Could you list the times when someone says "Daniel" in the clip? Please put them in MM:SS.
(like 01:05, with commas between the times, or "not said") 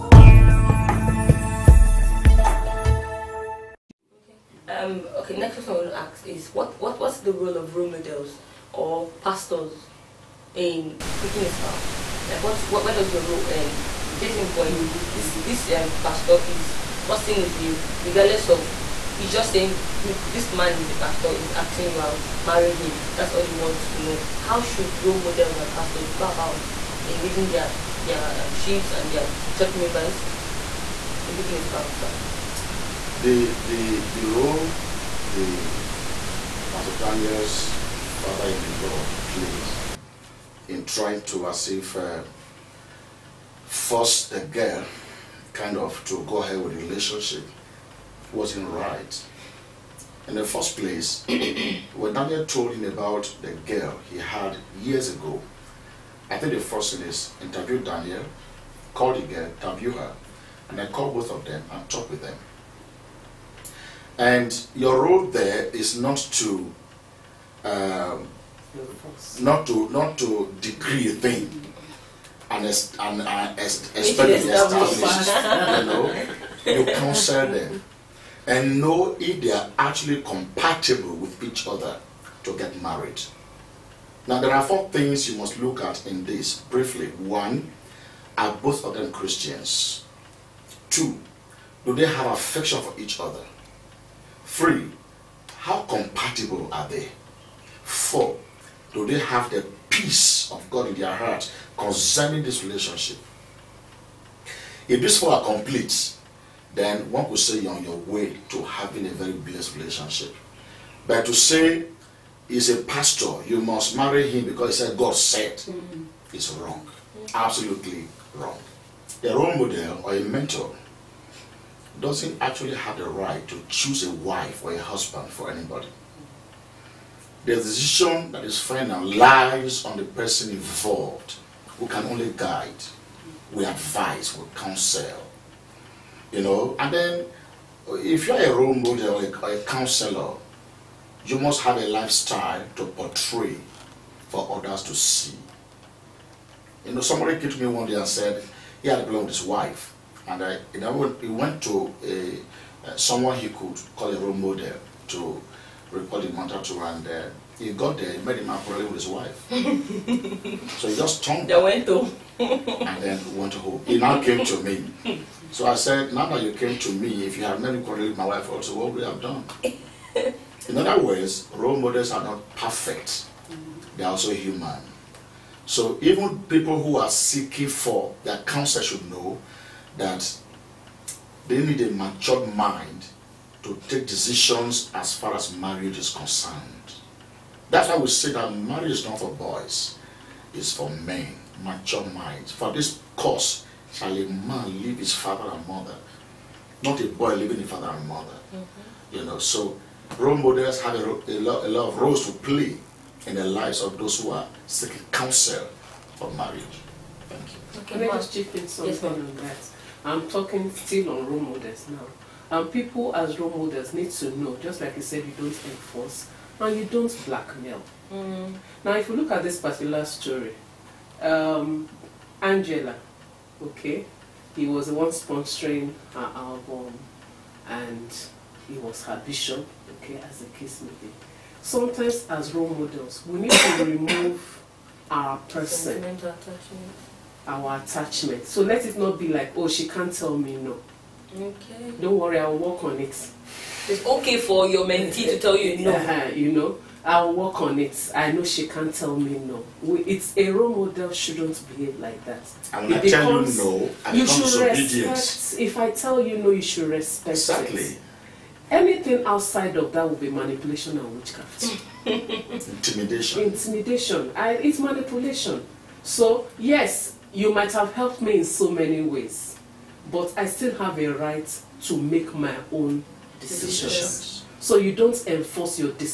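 00:36, 00:52, 00:57.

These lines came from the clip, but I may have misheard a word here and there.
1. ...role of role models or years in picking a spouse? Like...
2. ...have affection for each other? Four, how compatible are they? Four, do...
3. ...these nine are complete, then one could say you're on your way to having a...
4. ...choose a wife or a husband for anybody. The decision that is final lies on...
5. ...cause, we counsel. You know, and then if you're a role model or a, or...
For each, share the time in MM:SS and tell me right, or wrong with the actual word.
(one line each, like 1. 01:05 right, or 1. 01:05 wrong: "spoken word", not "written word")
1. 00:07 wrong: "pastors", not "years"
2. 01:32 wrong: "Three", not "Four"
3. 01:45 wrong: "four", not "nine"
4. 02:03 right
5. 02:13 wrong: "advise", not "cause".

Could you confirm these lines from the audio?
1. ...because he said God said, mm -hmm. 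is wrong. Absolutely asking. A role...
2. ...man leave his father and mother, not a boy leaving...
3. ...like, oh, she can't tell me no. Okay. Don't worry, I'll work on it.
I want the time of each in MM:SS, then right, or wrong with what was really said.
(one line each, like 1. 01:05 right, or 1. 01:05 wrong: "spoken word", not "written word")
1. 01:54 wrong: "wrong", not "asking"
2. 03:14 right
3. 03:59 right.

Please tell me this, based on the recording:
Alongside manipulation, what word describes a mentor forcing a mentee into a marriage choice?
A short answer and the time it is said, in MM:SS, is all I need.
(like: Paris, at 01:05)
Witchcraft, at 04:21.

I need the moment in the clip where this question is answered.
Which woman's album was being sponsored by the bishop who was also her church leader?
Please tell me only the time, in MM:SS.
03:42.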